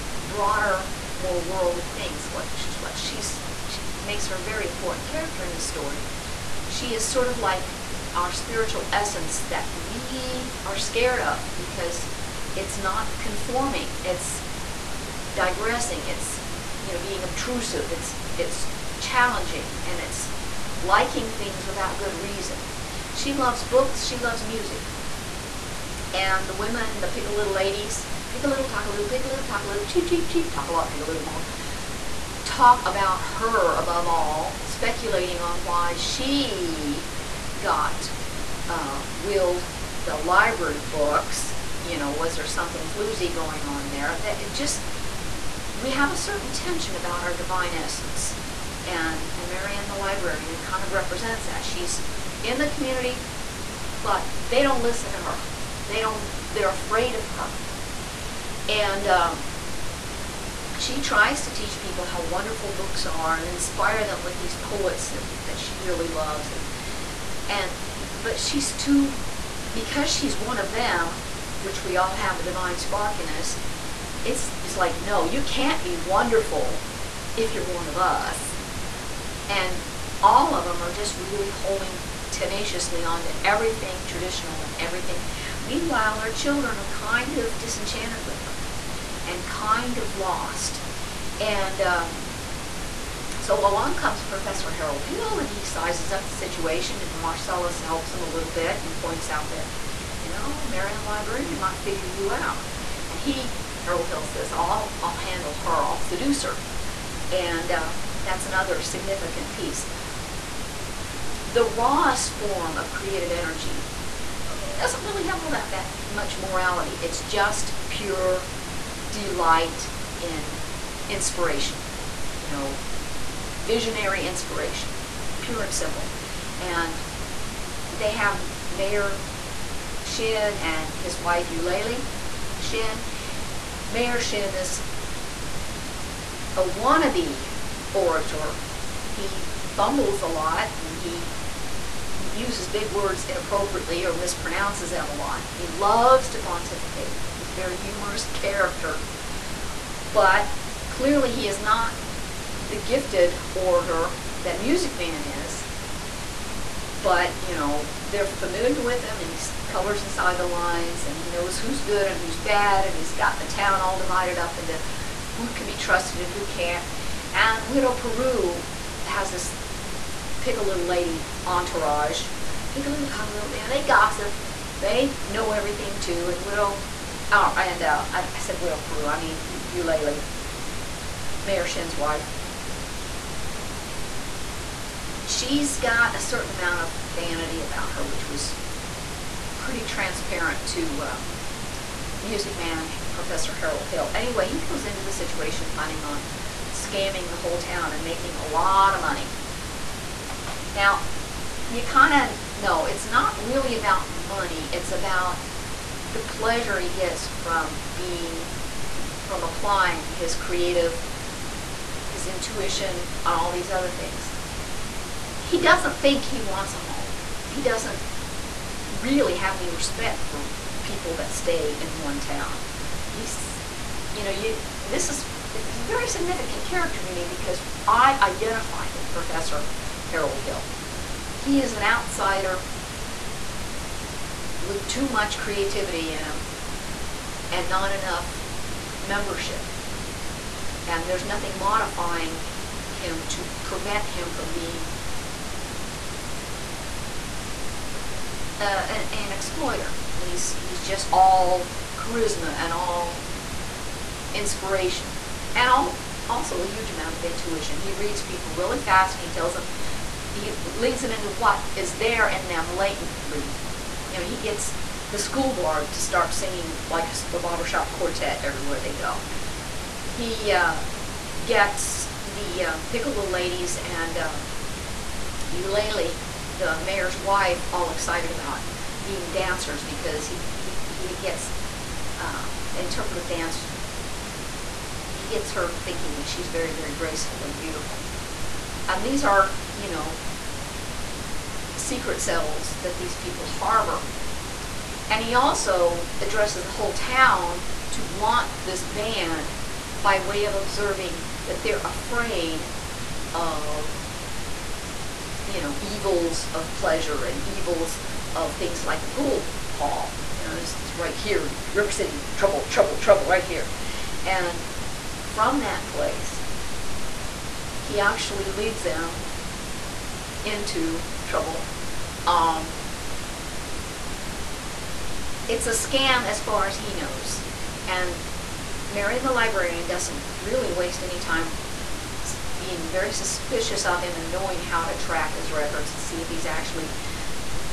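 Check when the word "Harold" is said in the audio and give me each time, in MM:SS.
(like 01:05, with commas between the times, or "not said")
01:34, 01:43, 03:13, 03:50.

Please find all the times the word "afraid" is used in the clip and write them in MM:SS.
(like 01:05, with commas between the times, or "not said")
00:56, 05:01.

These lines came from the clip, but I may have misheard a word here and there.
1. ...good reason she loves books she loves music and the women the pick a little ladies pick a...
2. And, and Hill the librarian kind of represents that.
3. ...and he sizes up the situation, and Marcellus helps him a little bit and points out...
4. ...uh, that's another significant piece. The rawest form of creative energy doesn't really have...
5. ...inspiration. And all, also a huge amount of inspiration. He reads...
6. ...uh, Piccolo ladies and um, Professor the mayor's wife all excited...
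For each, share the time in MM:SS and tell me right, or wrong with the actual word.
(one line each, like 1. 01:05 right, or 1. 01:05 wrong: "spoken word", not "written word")
1. 00:21 right
2. 00:48 wrong: "Marianne", not "Hill"
3. 01:35 right
4. 01:47 right
5. 04:14 wrong: "intuition", not "inspiration"
6. 04:32 wrong: "Eulalie", not "Professor".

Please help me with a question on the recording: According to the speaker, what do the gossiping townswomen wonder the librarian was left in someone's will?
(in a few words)
library books.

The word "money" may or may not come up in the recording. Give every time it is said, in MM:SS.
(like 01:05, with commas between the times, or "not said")
03:19, 03:24.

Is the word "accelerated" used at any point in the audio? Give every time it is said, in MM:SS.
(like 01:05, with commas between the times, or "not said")
not said.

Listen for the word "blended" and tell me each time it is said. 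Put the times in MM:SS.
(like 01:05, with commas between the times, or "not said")
not said.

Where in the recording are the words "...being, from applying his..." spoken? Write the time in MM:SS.
03:27.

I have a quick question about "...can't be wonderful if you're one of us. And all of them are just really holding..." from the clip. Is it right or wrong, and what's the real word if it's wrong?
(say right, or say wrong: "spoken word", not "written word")
right.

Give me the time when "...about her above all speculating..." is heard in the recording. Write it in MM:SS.
00:32.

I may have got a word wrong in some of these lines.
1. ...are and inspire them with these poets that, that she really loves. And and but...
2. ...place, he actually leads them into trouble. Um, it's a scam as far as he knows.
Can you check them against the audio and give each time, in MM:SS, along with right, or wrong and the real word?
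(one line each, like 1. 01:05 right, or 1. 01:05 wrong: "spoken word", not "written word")
1. 01:03 right
2. 05:15 right.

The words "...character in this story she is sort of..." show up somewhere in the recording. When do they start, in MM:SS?
00:05.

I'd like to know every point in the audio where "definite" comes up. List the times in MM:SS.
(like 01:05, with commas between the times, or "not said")
not said.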